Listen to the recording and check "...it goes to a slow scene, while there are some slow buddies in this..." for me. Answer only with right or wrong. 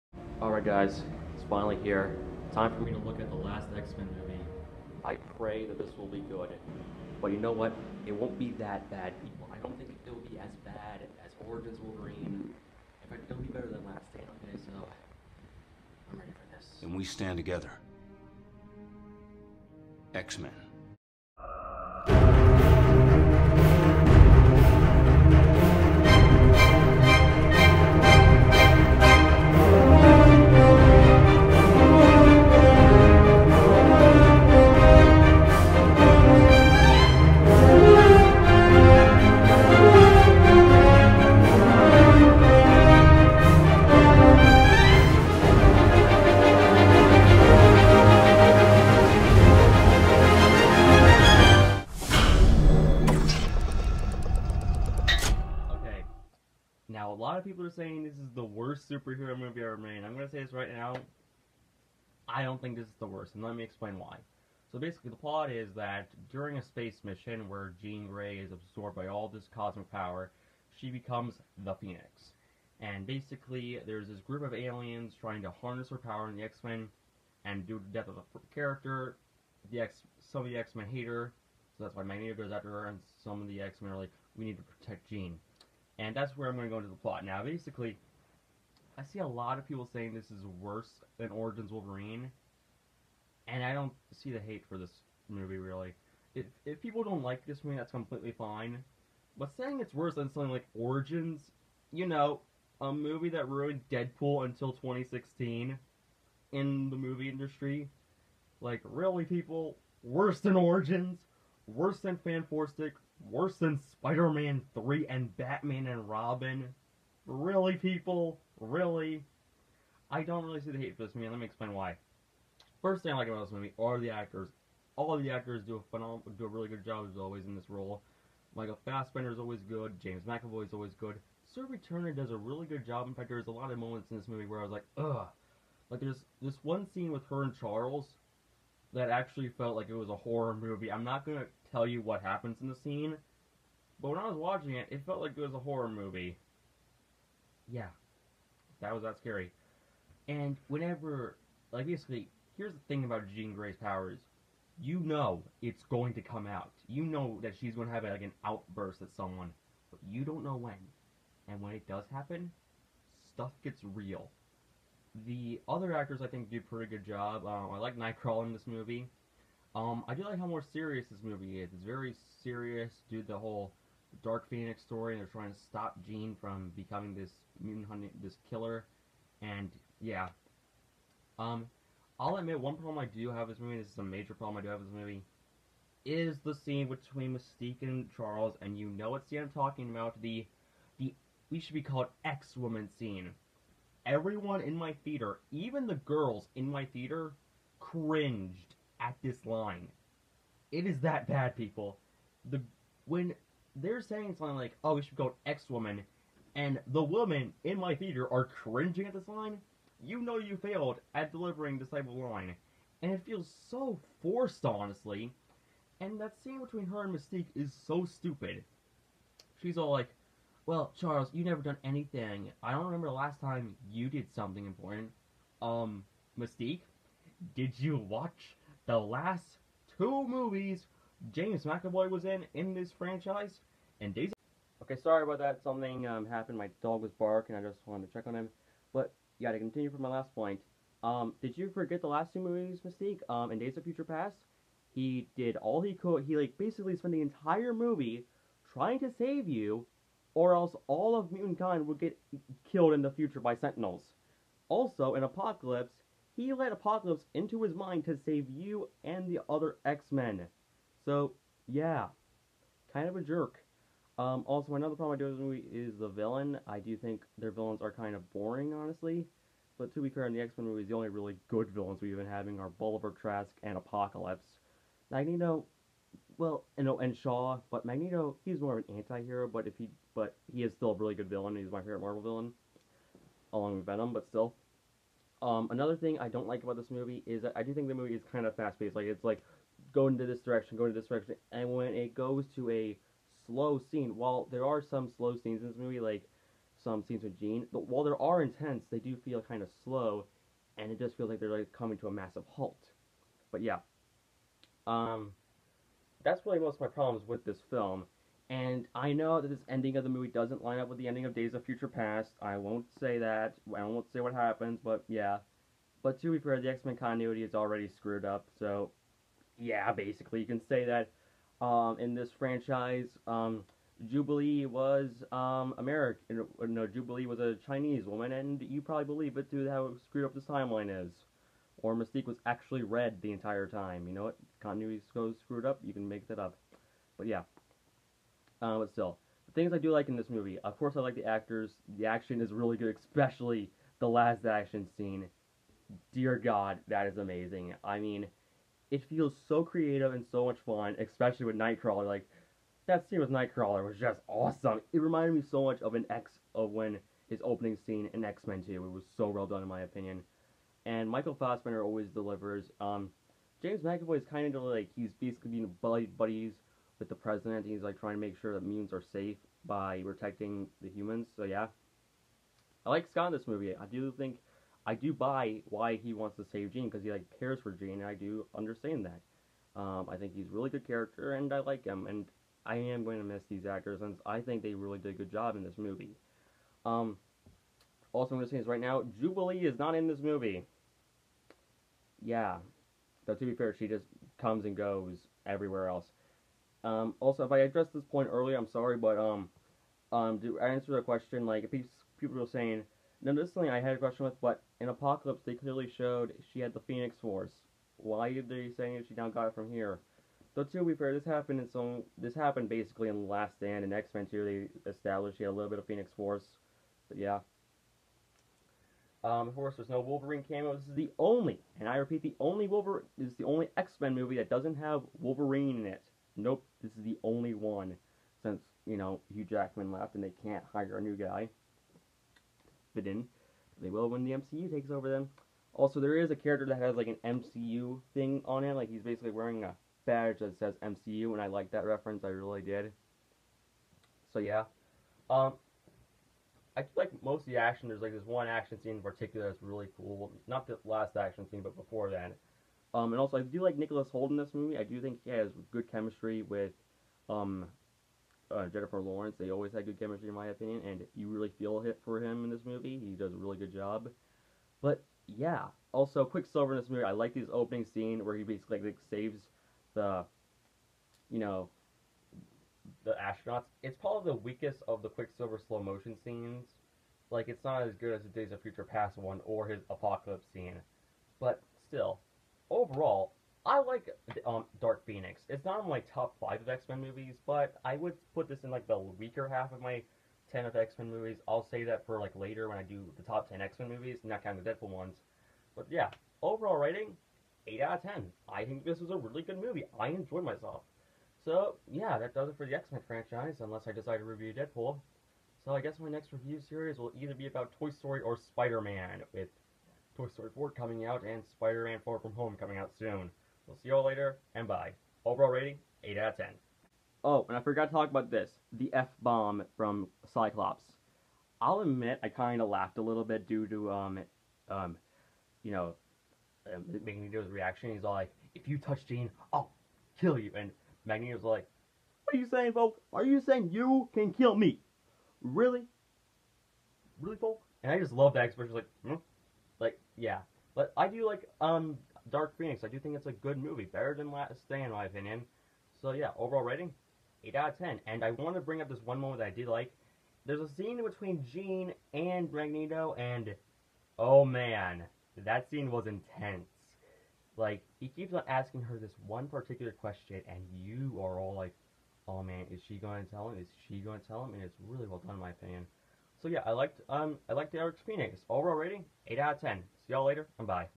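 wrong.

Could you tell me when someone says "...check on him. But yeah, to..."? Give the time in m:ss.
3:58.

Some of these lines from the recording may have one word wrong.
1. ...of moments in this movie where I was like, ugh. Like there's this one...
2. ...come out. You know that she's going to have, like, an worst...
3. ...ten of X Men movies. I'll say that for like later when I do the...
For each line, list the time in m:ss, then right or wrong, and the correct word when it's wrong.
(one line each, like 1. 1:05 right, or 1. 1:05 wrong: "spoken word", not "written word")
1. 2:13 right
2. 2:36 wrong: "outburst", not "worst"
3. 8:10 right.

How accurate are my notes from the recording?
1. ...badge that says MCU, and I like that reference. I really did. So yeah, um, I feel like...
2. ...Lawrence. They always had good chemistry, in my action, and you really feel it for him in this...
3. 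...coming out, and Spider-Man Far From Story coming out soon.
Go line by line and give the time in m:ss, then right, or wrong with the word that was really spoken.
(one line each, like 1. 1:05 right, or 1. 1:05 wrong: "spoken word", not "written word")
1. 7:20 right
2. 7:38 wrong: "opinion", not "action"
3. 8:30 wrong: "Home", not "Story".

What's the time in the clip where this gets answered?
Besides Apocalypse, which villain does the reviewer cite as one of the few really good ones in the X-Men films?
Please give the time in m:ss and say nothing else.
4:32.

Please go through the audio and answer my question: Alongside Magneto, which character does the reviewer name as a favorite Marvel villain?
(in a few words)
Venom.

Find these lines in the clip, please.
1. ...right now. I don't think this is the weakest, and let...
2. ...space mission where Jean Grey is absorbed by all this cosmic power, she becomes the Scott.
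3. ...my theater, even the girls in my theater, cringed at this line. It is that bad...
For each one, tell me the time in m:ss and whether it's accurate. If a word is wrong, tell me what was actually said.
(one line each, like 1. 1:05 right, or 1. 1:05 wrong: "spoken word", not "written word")
1. 1:00 wrong: "worst", not "weakest"
2. 1:06 wrong: "Phoenix", not "Scott"
3. 3:14 right.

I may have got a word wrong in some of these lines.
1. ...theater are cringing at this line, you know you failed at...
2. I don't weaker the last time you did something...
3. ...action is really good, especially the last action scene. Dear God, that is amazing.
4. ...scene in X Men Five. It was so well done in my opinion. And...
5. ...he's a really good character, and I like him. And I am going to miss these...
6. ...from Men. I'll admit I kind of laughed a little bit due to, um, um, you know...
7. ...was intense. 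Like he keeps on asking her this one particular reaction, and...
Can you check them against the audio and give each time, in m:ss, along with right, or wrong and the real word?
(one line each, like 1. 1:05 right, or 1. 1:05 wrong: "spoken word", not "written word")
1. 3:27 right
2. 3:42 wrong: "remember", not "weaker"
3. 5:42 right
4. 5:57 wrong: "Two", not "Five"
5. 6:20 right
6. 8:39 wrong: "Cyclops", not "Men"
7. 9:15 wrong: "question", not "reaction".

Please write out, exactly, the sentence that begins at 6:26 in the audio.
Um, also, I'm going to say this right now: Jubilee is not in this movie.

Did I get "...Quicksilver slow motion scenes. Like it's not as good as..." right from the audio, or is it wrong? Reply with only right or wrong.
right.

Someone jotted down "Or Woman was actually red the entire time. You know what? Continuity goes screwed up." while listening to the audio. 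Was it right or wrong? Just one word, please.
wrong.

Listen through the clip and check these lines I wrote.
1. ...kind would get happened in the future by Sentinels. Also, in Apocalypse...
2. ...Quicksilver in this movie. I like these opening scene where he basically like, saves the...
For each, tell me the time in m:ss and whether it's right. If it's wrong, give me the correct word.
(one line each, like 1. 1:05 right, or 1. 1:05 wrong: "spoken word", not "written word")
1. 4:11 wrong: "killed", not "happened"
2. 7:46 right.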